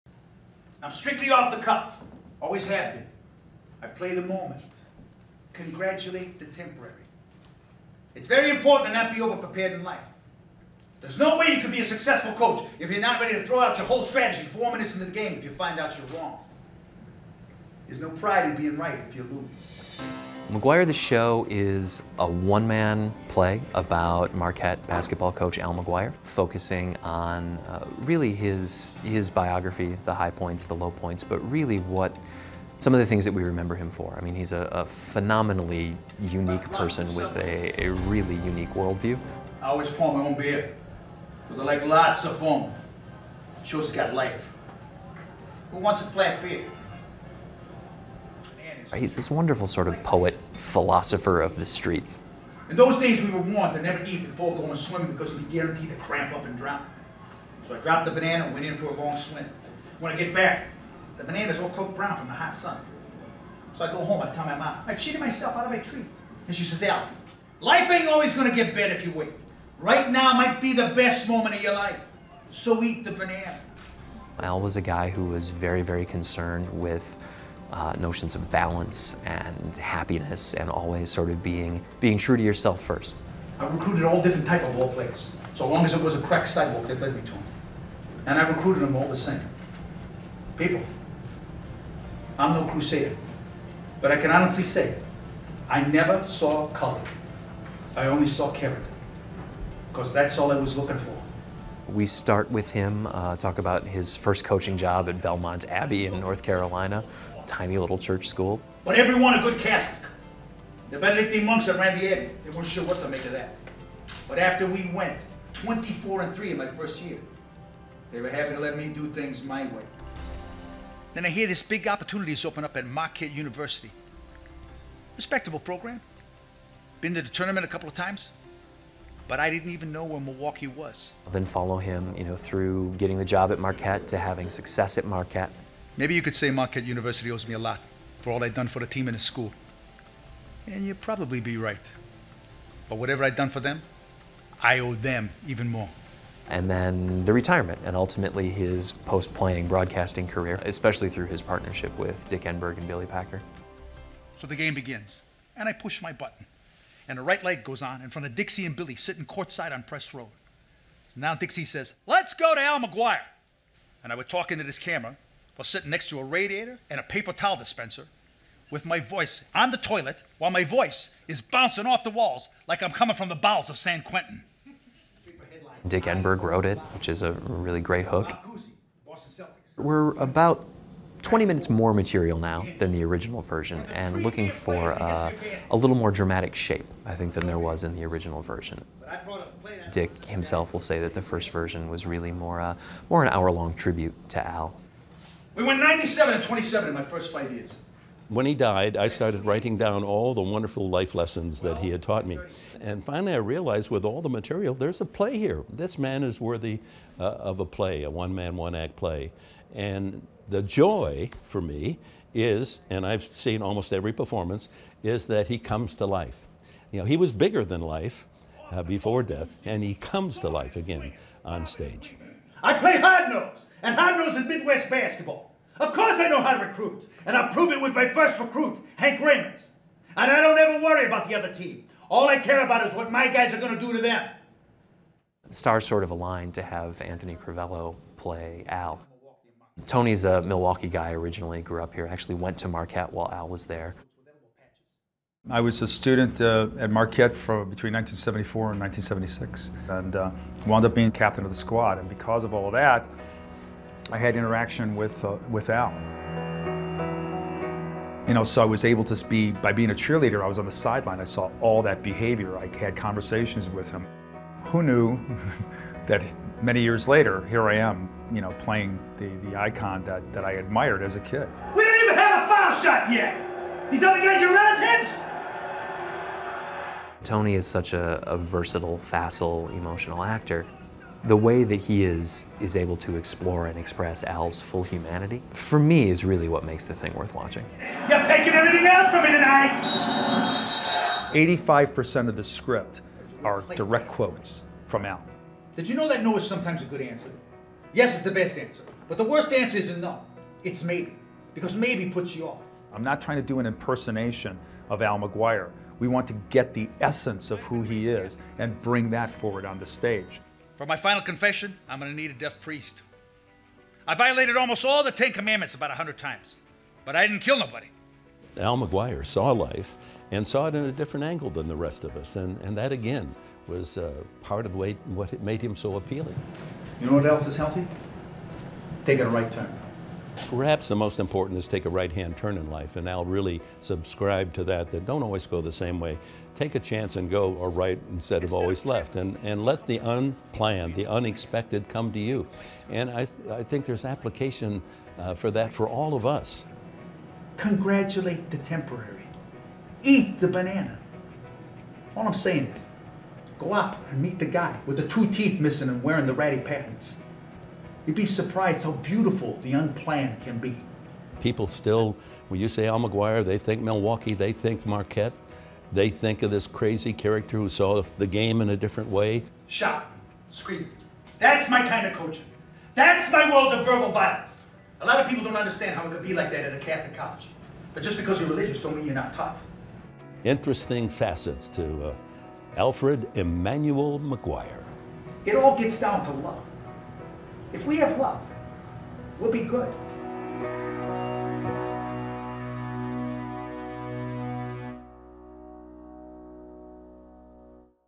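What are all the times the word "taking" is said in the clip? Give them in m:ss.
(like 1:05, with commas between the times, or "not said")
4:48, 5:29.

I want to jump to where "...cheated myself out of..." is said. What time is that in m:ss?
1:04.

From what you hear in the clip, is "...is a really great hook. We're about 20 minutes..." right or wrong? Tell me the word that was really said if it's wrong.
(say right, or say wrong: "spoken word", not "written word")
right.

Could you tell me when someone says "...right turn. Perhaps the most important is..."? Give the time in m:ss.
5:29.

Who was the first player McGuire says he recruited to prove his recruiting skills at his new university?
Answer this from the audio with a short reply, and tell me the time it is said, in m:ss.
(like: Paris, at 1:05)
Hank Reynolds, at 3:48.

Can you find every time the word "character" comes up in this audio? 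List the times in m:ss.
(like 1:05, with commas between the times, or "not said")
1:38, 6:07.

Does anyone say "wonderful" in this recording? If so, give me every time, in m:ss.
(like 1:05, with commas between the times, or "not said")
0:49, 3:20.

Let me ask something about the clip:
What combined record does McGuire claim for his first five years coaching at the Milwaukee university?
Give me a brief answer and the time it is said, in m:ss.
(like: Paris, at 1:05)
97 and 27, at 3:15.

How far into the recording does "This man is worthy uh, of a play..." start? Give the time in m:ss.
3:25.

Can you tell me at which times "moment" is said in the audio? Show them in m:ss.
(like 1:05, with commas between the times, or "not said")
0:04, 1:11.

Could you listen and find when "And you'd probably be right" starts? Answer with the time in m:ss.
2:20.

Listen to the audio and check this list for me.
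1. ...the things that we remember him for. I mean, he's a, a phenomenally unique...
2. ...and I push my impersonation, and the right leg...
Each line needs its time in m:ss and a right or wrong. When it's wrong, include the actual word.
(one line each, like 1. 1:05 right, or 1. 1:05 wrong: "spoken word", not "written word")
1. 0:32 right
2. 2:35 wrong: "button", not "impersonation".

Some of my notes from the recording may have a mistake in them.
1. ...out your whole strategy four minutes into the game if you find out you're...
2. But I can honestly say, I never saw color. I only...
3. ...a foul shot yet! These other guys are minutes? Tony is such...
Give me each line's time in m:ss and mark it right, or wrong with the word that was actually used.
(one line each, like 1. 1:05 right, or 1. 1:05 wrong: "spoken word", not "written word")
1. 0:13 right
2. 1:34 right
3. 4:32 wrong: "relatives", not "minutes".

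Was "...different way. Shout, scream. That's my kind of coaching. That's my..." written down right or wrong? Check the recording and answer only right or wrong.
right.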